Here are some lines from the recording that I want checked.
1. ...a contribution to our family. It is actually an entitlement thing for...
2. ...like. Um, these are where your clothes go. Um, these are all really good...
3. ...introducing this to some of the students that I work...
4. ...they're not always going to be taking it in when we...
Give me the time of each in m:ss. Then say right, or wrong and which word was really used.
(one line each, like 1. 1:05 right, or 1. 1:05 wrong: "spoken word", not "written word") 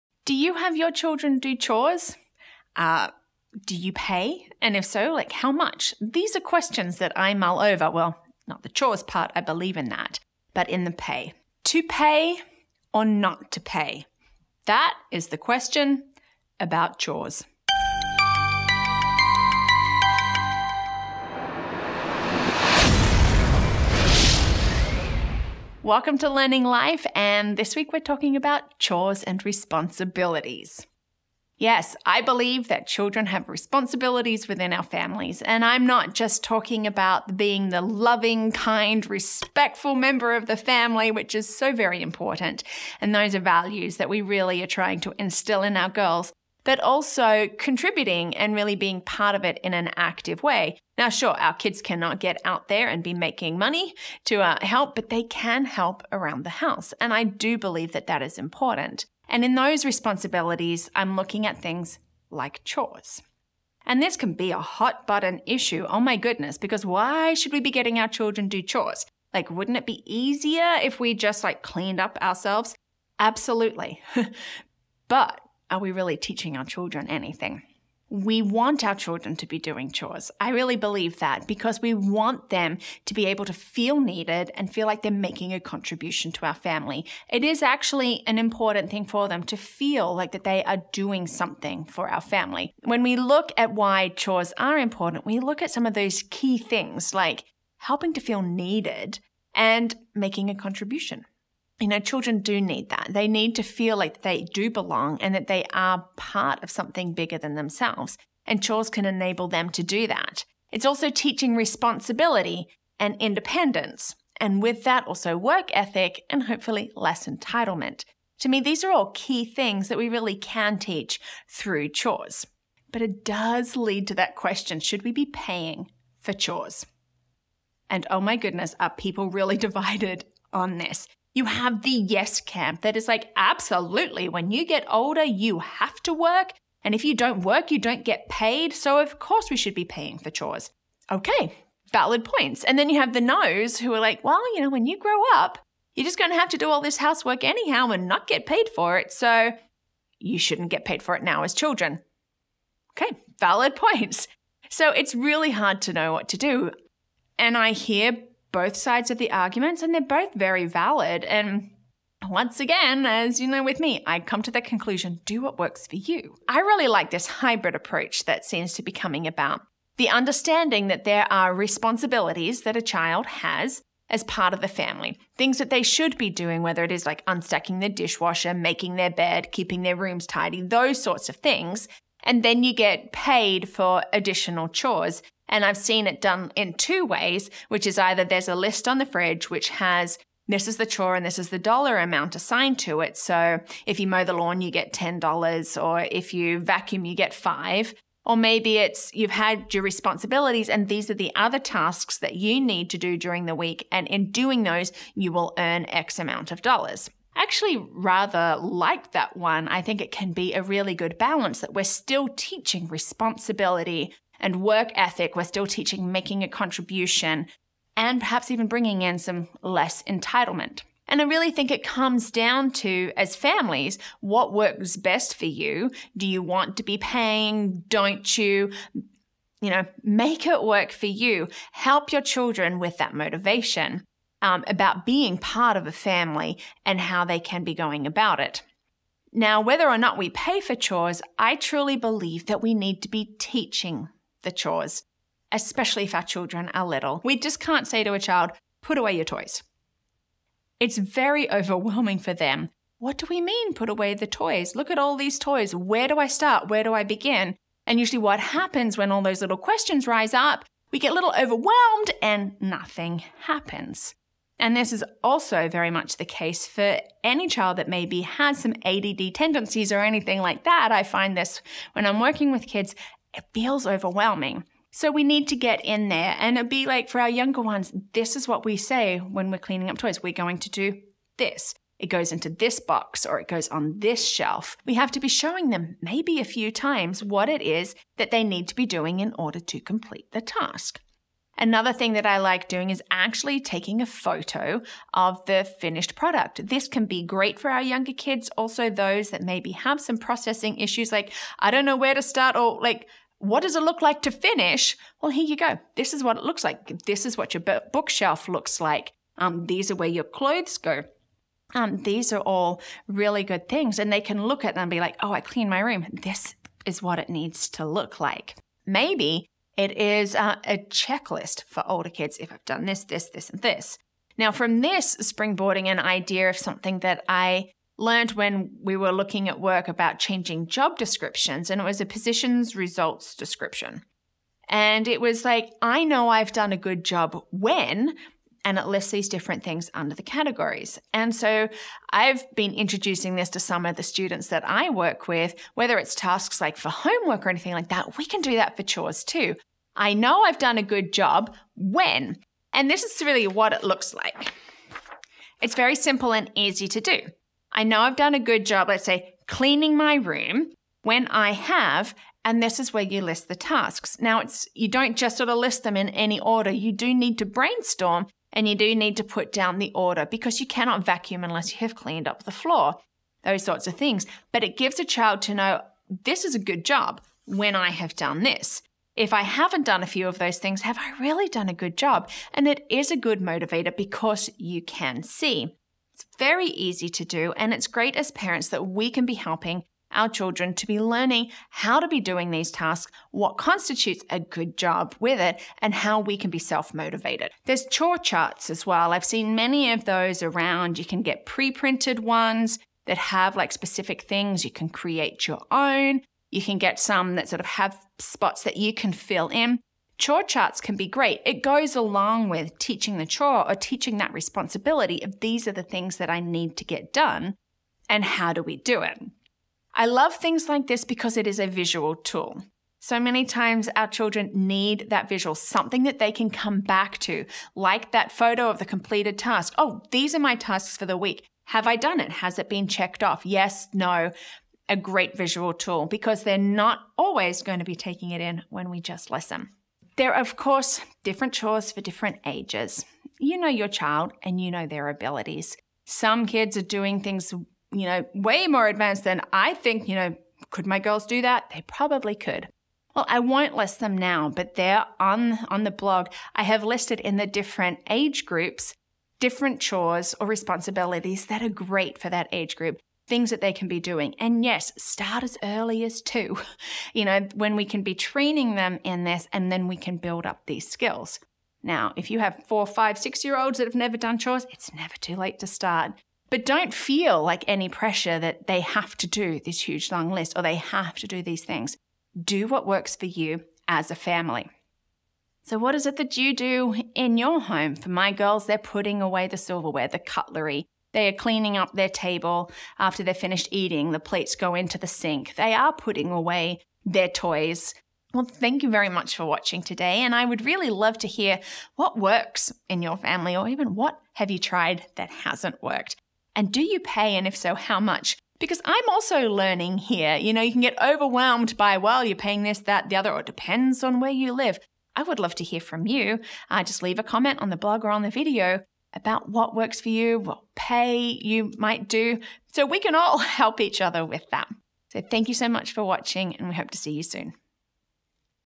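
1. 1:25 wrong: "important", not "entitlement"
2. 5:08 right
3. 5:42 right
4. 7:16 right.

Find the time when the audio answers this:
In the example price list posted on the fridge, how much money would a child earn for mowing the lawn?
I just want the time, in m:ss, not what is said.
3:14.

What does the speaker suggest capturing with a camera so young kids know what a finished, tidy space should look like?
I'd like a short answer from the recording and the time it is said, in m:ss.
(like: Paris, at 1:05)
a photo of the finished product, at 4:54.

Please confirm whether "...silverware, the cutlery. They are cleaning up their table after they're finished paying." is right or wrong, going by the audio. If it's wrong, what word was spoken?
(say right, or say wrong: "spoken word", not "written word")
wrong: "eating", not "paying".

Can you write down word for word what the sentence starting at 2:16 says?
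And if you don't work, you don't get paid.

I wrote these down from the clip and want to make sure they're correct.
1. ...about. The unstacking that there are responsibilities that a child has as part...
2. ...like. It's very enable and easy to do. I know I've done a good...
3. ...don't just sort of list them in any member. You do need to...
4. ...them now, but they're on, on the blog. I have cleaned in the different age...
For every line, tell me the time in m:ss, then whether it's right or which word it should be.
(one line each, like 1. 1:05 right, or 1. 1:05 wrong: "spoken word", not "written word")
1. 2:49 wrong: "understanding", not "unstacking"
2. 5:54 wrong: "simple", not "enable"
3. 6:04 wrong: "order", not "member"
4. 7:33 wrong: "listed", not "cleaned".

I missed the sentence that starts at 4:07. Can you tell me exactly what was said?
We just can't say to a child, put away your toys.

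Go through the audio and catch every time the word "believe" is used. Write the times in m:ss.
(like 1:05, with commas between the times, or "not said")
0:09, 0:32, 0:57, 1:20, 4:01.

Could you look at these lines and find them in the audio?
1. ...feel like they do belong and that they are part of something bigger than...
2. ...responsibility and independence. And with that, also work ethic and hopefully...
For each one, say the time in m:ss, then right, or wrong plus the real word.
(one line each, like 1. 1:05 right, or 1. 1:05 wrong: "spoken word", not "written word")
1. 1:43 right
2. 1:51 right.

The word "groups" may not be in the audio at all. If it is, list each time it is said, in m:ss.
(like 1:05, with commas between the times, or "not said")
7:38, 7:42.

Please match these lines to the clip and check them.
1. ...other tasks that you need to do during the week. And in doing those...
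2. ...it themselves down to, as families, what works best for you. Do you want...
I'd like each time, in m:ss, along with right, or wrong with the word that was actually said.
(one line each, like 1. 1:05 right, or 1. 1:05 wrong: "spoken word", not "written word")
1. 3:21 right
2. 3:41 wrong: "comes", not "themselves".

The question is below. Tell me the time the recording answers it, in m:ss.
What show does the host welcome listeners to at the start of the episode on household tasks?
0:26.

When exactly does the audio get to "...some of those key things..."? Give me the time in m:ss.
1:35.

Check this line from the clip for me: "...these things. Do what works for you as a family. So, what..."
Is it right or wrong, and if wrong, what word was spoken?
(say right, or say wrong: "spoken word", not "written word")
right.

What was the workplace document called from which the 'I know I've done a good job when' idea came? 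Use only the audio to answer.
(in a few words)
positions results description.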